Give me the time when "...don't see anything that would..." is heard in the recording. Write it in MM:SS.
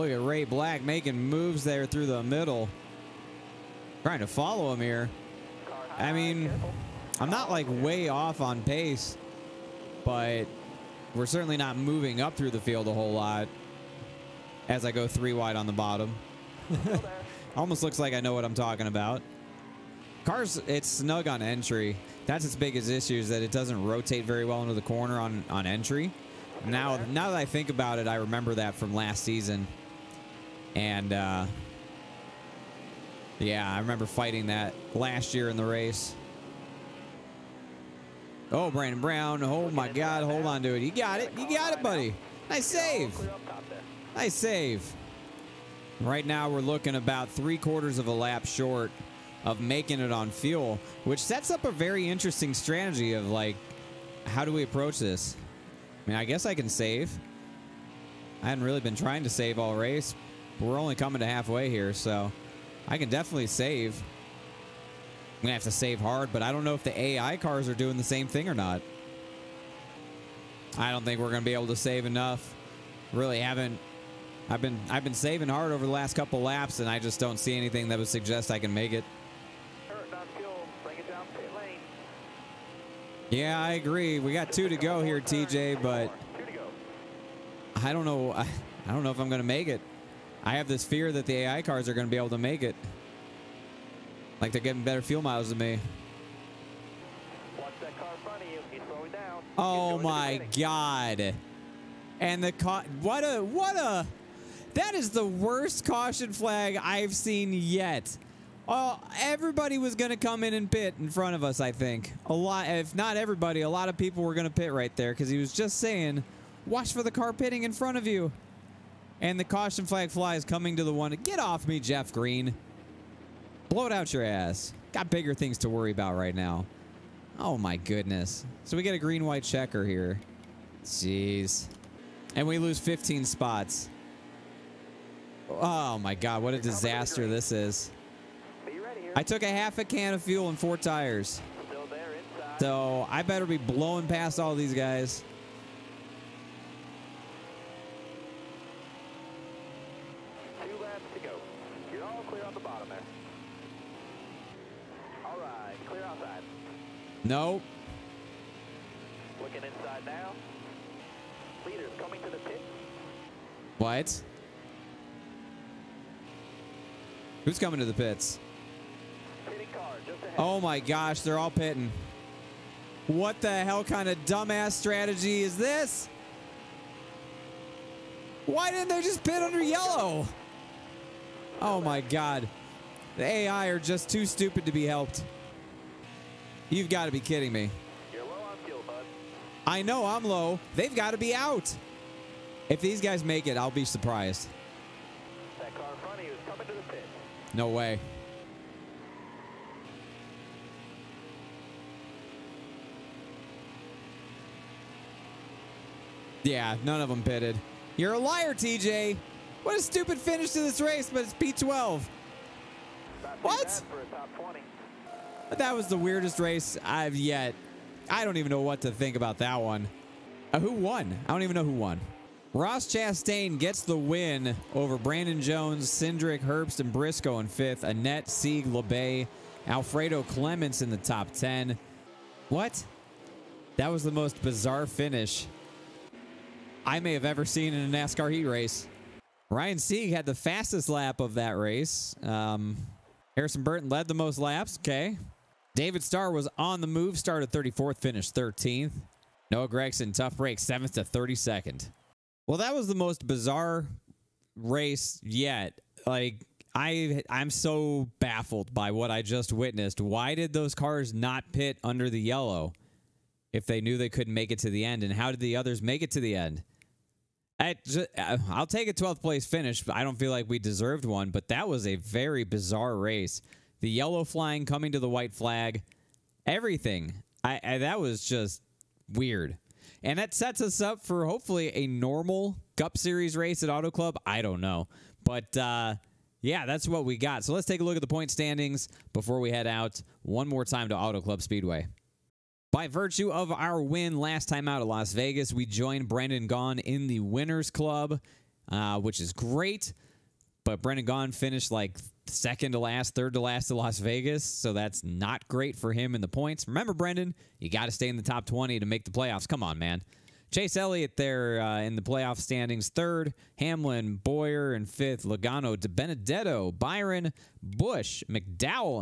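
01:17.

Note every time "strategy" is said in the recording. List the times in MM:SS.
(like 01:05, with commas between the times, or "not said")
00:52, 02:54.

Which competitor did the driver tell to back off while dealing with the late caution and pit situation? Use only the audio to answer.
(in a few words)
Jeff Green.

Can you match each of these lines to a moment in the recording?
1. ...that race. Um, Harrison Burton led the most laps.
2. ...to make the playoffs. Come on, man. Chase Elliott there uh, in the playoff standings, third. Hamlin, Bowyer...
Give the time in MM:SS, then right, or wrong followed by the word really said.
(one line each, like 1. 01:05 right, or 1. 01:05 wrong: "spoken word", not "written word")
1. 04:01 right
2. 05:08 right.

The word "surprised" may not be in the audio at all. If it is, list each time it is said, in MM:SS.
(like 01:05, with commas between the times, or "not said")
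03:13.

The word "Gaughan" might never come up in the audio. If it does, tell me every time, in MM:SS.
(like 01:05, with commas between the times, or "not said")
04:56, 05:01.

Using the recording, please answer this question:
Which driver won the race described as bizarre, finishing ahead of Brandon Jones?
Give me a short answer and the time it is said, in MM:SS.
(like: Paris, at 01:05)
Ross Chastain, at 03:42.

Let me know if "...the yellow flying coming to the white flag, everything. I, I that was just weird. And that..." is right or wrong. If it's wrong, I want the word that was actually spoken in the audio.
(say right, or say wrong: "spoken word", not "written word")
right.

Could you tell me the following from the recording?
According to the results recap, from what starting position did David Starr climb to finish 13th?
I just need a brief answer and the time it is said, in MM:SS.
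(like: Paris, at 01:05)
34th, at 04:07.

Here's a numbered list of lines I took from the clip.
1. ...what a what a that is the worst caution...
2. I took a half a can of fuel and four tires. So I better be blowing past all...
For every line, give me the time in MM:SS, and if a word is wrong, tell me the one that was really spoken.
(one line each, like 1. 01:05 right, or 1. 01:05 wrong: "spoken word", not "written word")
1. 01:43 right
2. 02:19 right.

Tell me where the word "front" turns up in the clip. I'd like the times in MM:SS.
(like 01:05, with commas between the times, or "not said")
01:51, 01:57.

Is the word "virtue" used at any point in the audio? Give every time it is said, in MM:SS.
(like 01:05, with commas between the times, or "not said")
04:52.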